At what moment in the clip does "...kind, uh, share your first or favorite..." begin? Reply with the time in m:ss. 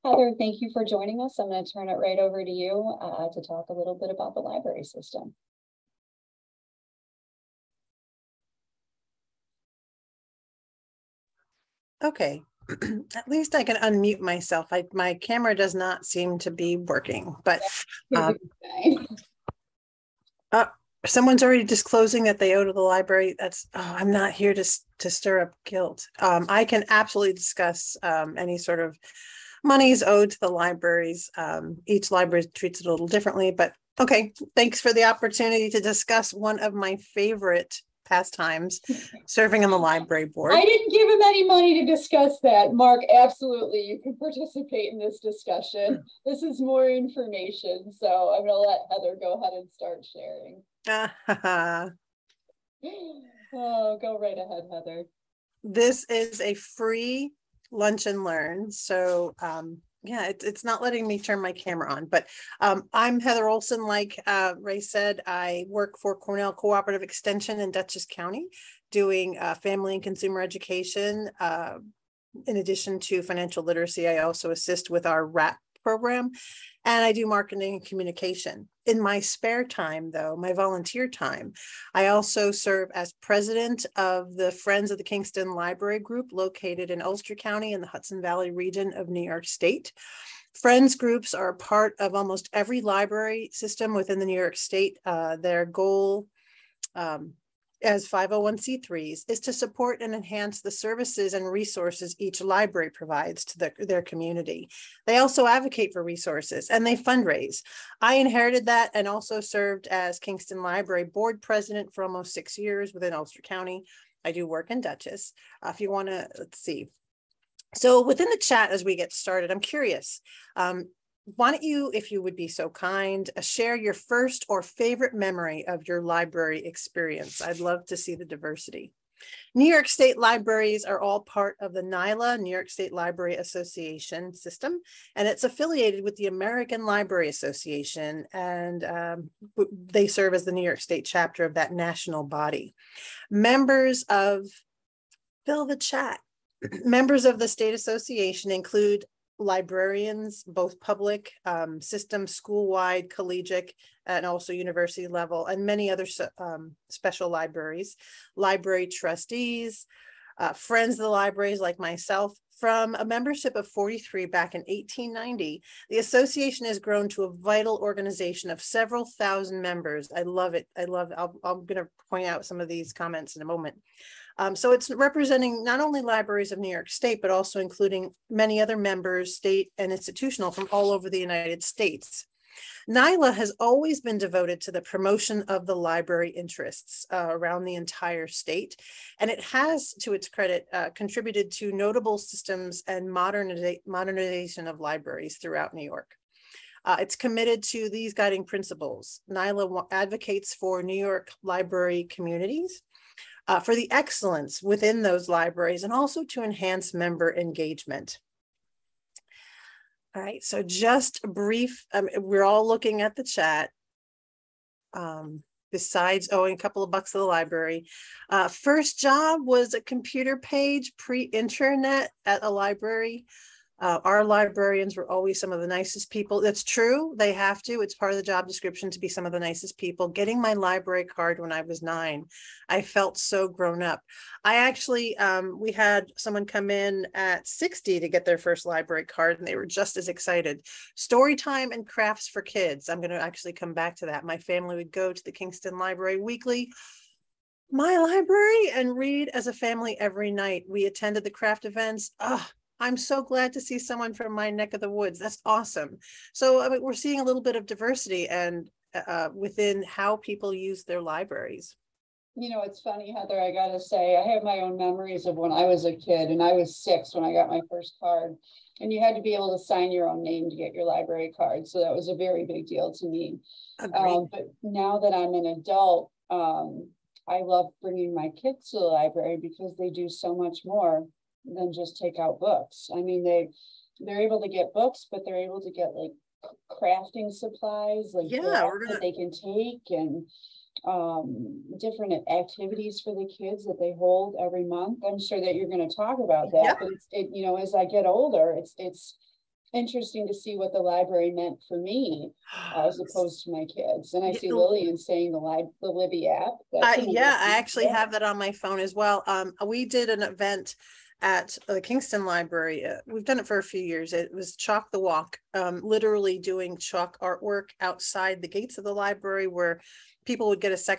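2:02.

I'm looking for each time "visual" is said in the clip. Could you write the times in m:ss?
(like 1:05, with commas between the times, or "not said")
not said.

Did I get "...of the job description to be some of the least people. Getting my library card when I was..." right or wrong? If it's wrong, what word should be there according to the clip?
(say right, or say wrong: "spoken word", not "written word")
wrong: "nicest", not "least".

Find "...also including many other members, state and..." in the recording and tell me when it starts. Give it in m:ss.
2:57.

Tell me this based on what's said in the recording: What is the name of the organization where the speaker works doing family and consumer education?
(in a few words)
Cornell Cooperative Extension.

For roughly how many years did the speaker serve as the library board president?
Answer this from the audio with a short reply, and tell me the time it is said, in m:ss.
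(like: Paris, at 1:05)
almost six years, at 1:52.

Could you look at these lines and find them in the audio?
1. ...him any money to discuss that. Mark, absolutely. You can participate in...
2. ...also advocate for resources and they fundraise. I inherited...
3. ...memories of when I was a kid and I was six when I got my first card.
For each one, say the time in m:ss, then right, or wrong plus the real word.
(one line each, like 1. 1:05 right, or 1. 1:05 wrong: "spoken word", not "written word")
1. 0:41 right
2. 1:45 right
3. 4:24 right.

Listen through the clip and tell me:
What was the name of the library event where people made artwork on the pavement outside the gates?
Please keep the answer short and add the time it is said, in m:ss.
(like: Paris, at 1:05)
Chalk the Walk, at 5:14.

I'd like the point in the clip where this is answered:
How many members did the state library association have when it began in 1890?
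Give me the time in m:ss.
2:43.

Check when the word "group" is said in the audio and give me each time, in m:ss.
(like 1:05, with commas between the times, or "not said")
1:26, 1:30.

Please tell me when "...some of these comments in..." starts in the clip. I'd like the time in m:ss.
2:52.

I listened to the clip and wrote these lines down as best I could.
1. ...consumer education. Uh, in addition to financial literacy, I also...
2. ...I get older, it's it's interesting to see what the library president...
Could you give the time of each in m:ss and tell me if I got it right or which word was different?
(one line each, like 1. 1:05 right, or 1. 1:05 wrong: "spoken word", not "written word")
1. 1:10 right
2. 4:57 wrong: "meant", not "president".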